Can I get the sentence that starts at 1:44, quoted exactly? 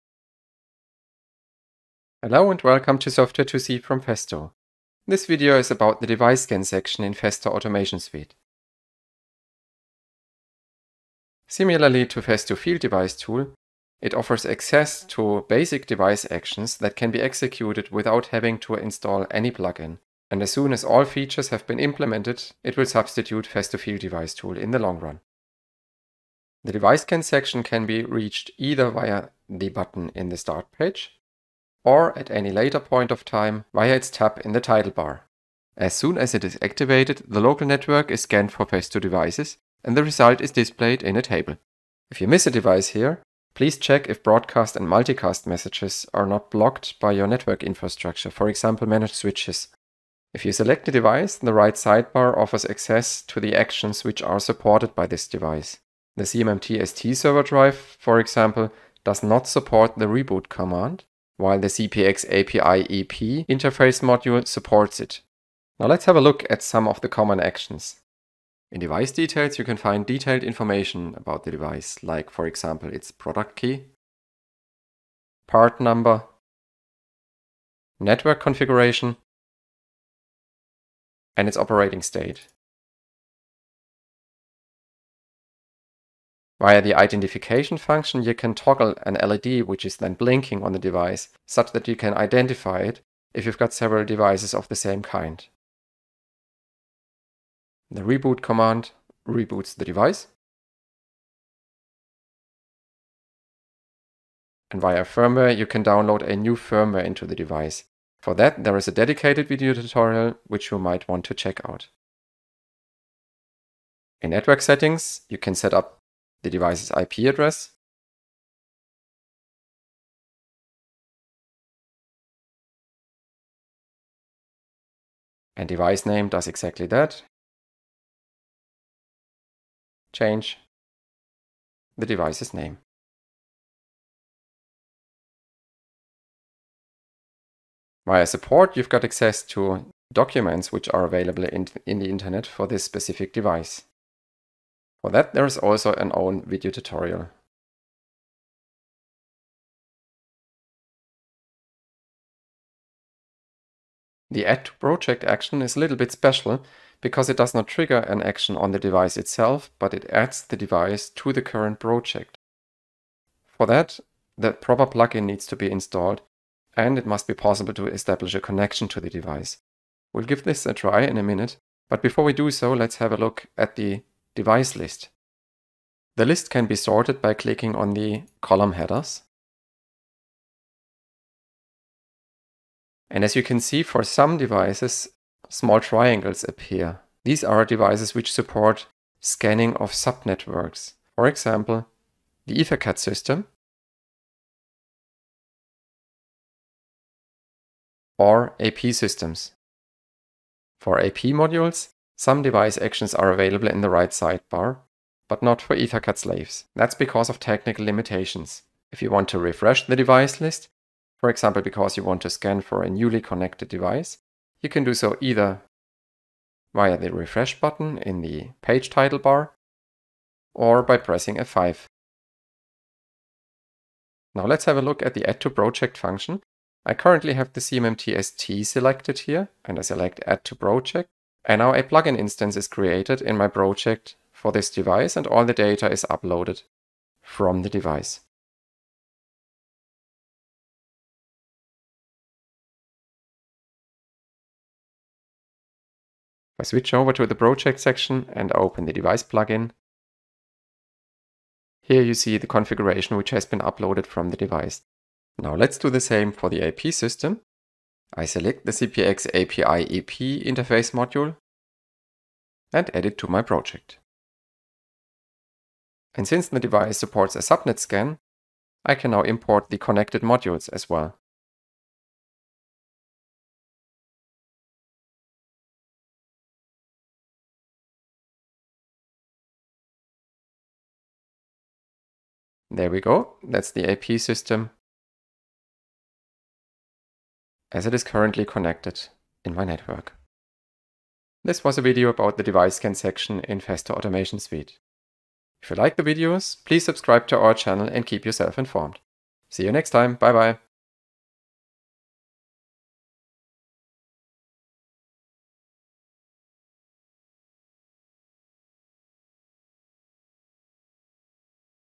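And via firmware, you can download a new firmware into the device.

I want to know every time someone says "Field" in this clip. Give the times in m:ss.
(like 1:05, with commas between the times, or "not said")
0:12, 0:23.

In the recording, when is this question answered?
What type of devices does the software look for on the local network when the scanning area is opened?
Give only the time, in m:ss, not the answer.
0:38.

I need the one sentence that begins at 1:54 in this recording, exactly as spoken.
In network settings, you can set up the device's IP address.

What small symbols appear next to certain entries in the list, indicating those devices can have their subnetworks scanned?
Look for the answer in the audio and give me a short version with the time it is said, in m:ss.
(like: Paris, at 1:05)
triangles, at 3:05.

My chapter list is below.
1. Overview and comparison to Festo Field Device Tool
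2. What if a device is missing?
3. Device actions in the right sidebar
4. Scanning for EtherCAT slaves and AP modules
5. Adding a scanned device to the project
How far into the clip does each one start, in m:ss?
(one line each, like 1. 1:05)
1. 0:10
2. 0:40
3. 0:50
4. 3:01
5. 3:42.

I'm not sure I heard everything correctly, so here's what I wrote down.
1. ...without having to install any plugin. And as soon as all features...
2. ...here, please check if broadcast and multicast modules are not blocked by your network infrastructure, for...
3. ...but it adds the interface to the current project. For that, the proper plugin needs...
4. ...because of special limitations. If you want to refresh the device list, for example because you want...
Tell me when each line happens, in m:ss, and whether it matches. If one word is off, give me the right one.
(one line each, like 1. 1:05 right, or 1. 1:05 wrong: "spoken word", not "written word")
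1. 0:17 right
2. 0:42 wrong: "messages", not "modules"
3. 2:39 wrong: "device", not "interface"
4. 3:26 wrong: "technical", not "special".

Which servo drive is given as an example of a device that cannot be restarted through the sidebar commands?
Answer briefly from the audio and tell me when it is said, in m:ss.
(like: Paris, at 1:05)
CMMT ST, at 0:56.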